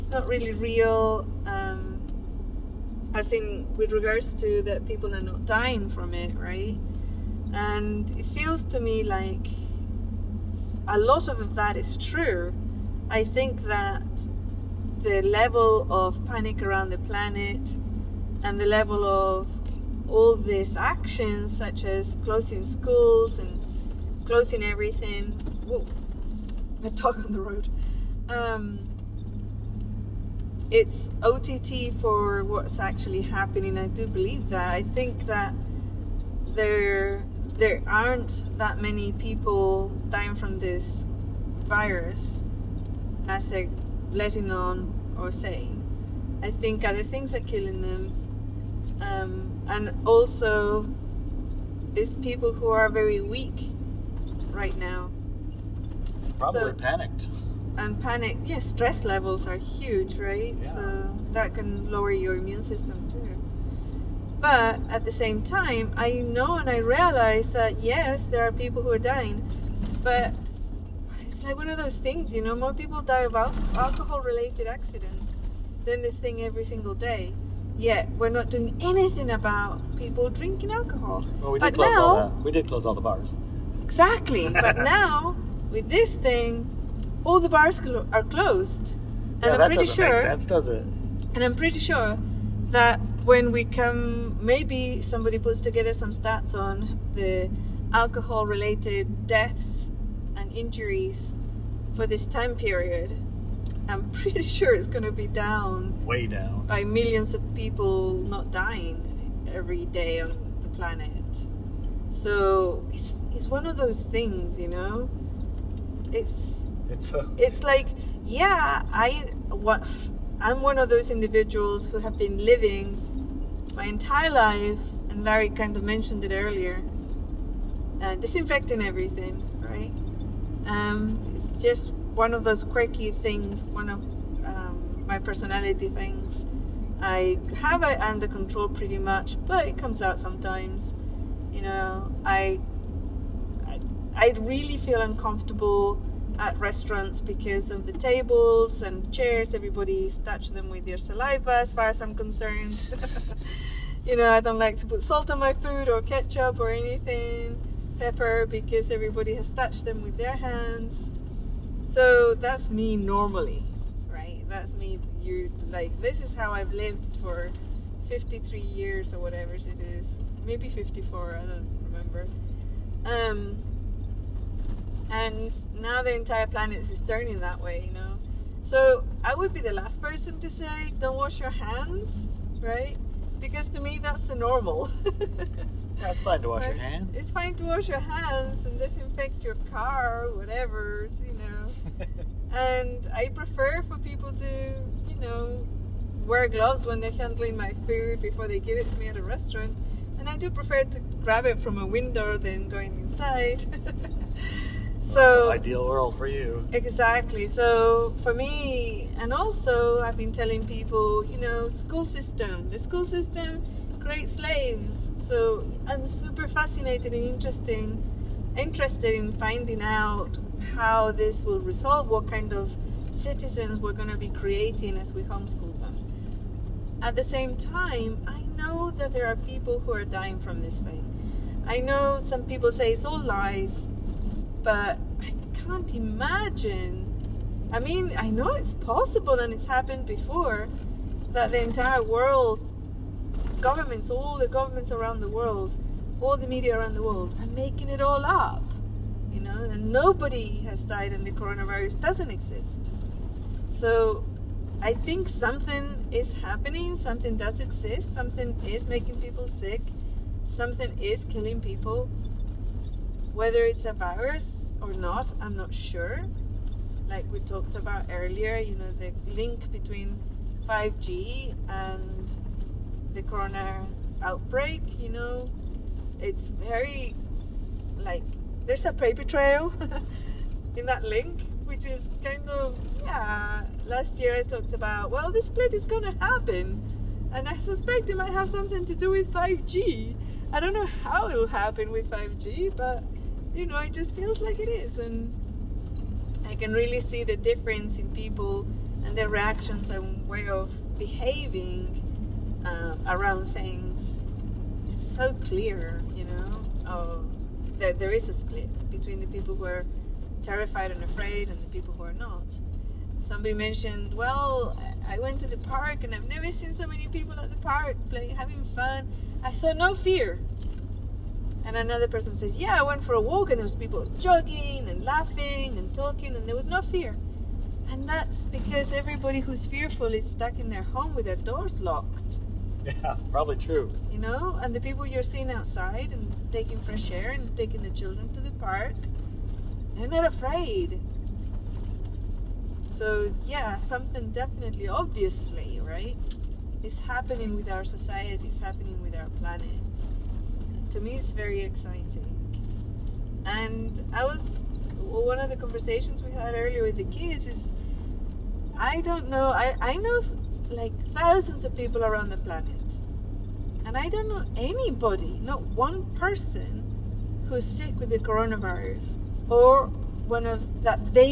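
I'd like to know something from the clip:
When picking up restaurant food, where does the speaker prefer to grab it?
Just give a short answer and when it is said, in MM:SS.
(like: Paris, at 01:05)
a window, at 03:21.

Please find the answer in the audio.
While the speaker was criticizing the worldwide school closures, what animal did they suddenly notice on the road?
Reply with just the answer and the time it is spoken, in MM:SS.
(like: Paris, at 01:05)
dog, at 00:26.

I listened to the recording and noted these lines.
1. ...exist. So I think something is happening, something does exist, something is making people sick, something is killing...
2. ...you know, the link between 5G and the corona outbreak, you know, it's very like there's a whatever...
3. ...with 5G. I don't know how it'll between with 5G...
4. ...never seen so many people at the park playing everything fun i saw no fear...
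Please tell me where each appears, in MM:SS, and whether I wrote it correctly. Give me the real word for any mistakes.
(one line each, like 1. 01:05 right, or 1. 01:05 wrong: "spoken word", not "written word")
1. 04:12 right
2. 04:28 wrong: "paper", not "whatever"
3. 04:49 wrong: "happen", not "between"
4. 05:16 wrong: "having", not "everything".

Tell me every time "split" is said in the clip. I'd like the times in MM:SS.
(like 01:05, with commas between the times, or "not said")
04:45, 05:08.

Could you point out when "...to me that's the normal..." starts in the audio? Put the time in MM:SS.
03:03.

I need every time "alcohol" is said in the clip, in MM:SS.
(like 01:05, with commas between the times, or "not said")
01:13, 01:20, 01:37.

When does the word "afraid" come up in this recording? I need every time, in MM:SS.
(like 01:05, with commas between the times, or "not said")
05:11, 05:40.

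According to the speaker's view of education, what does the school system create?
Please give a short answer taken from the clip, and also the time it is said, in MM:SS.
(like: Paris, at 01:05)
slaves, at 03:34.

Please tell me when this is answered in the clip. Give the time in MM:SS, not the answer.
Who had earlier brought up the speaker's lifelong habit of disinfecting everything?
02:05.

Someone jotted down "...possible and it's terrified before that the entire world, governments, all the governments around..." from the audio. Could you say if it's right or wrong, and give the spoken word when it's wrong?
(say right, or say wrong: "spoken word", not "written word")
wrong: "happened", not "terrified".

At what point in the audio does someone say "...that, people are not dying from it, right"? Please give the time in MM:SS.
00:04.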